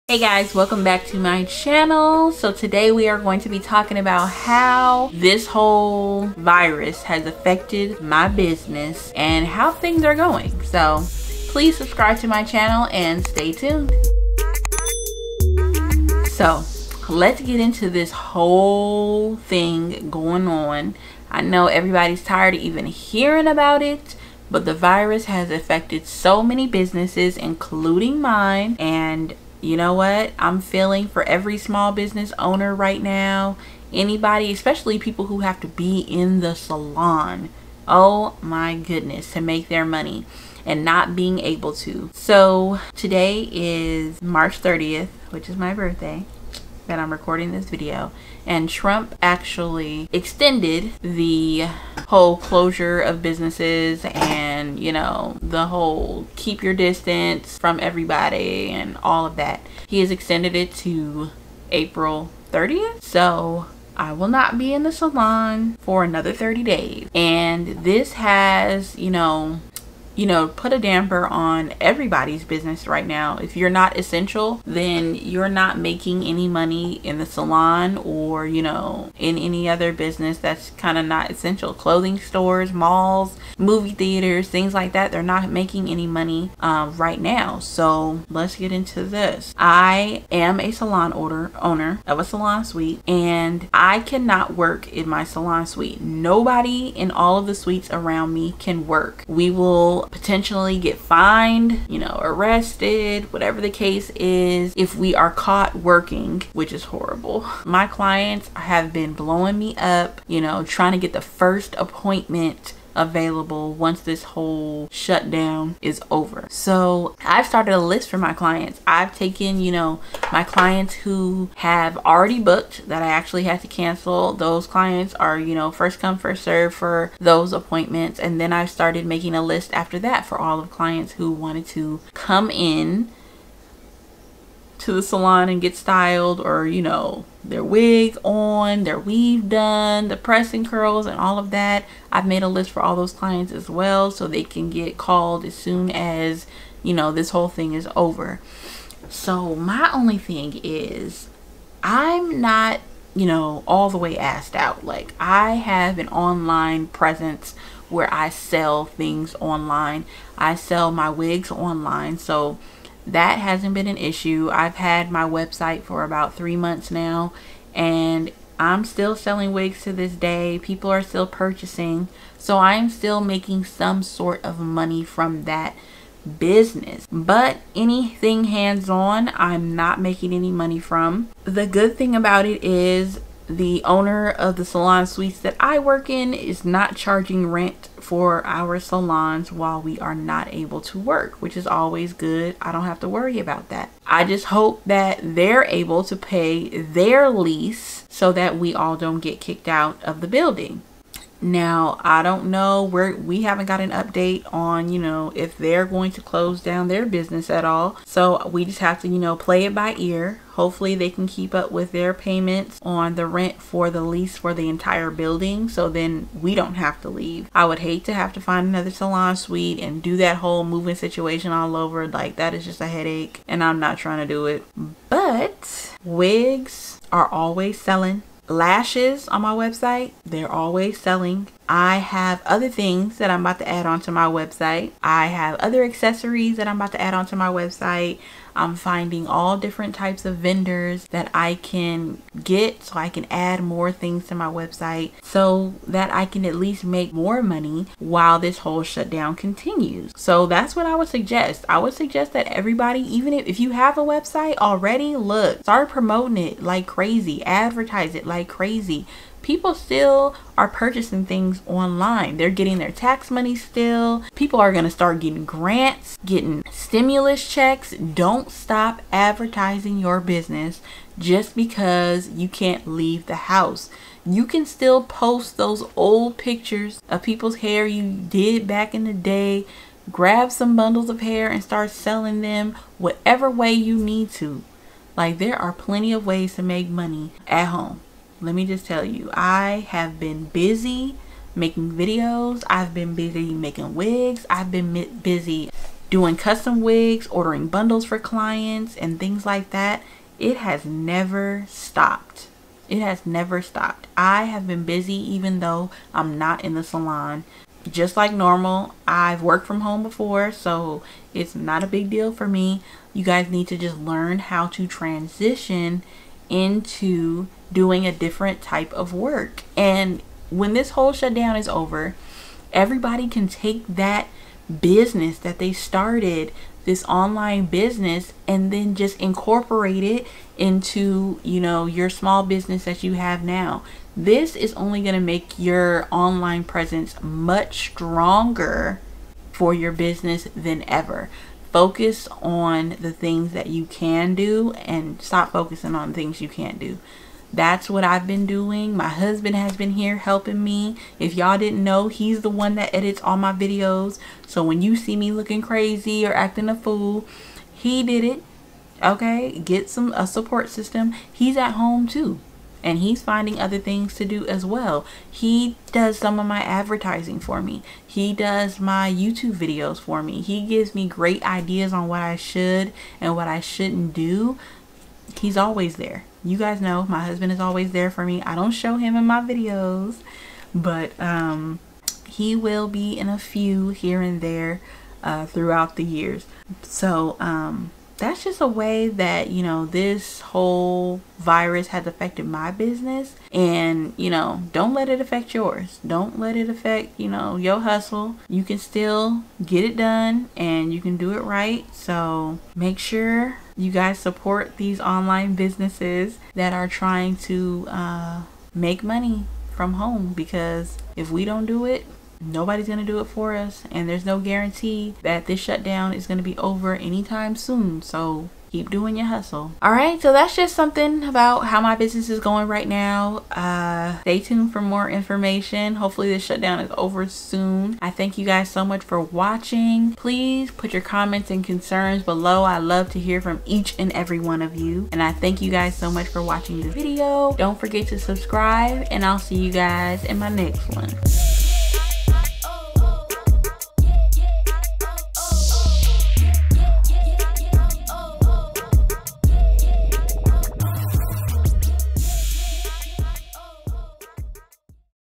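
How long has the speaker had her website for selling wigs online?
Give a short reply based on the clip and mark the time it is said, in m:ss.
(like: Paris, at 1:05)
About three months, at 2:46.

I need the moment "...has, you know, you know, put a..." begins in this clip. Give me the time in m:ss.
1:08.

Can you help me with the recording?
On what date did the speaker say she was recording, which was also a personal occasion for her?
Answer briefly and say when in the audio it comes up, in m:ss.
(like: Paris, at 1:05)
March 30th, at 0:44.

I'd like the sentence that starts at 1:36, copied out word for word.
Nobody in all of the suites around me can work.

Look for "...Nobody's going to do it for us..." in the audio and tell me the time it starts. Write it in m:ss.
6:52.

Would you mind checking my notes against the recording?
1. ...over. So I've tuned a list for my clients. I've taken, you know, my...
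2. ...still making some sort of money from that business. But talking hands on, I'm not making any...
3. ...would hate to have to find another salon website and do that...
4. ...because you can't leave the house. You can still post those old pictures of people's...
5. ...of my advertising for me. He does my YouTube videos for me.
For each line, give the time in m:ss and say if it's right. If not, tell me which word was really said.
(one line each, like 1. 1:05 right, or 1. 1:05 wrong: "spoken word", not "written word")
1. 1:56 wrong: "started", not "tuned"
2. 2:52 wrong: "anything", not "talking"
3. 3:37 wrong: "suite", not "website"
4. 4:31 right
5. 6:06 right.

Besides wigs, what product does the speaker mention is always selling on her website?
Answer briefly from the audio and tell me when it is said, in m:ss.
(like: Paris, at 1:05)
Lashes, at 3:48.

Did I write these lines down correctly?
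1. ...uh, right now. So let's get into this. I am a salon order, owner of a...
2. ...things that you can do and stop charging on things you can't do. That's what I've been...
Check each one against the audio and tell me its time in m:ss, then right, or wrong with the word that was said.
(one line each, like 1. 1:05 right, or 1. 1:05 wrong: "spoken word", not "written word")
1. 1:26 right
2. 5:43 wrong: "focusing", not "charging".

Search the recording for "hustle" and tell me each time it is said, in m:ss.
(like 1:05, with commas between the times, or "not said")
6:37, 6:59.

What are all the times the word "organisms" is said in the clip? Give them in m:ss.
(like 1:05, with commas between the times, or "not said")
not said.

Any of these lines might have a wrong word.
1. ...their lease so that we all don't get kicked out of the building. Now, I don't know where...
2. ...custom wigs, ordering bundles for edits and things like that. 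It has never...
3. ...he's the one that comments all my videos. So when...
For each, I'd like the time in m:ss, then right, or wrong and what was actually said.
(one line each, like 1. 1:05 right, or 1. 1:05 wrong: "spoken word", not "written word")
1. 3:16 right
2. 4:56 wrong: "clients", not "edits"
3. 5:52 wrong: "edits", not "comments".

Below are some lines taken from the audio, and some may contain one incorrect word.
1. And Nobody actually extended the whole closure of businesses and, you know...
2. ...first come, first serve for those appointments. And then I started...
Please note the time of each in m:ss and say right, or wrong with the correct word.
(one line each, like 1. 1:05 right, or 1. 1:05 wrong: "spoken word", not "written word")
1. 0:48 wrong: "Trump", not "Nobody"
2. 2:05 right.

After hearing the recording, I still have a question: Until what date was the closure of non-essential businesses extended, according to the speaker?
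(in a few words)
April 30th.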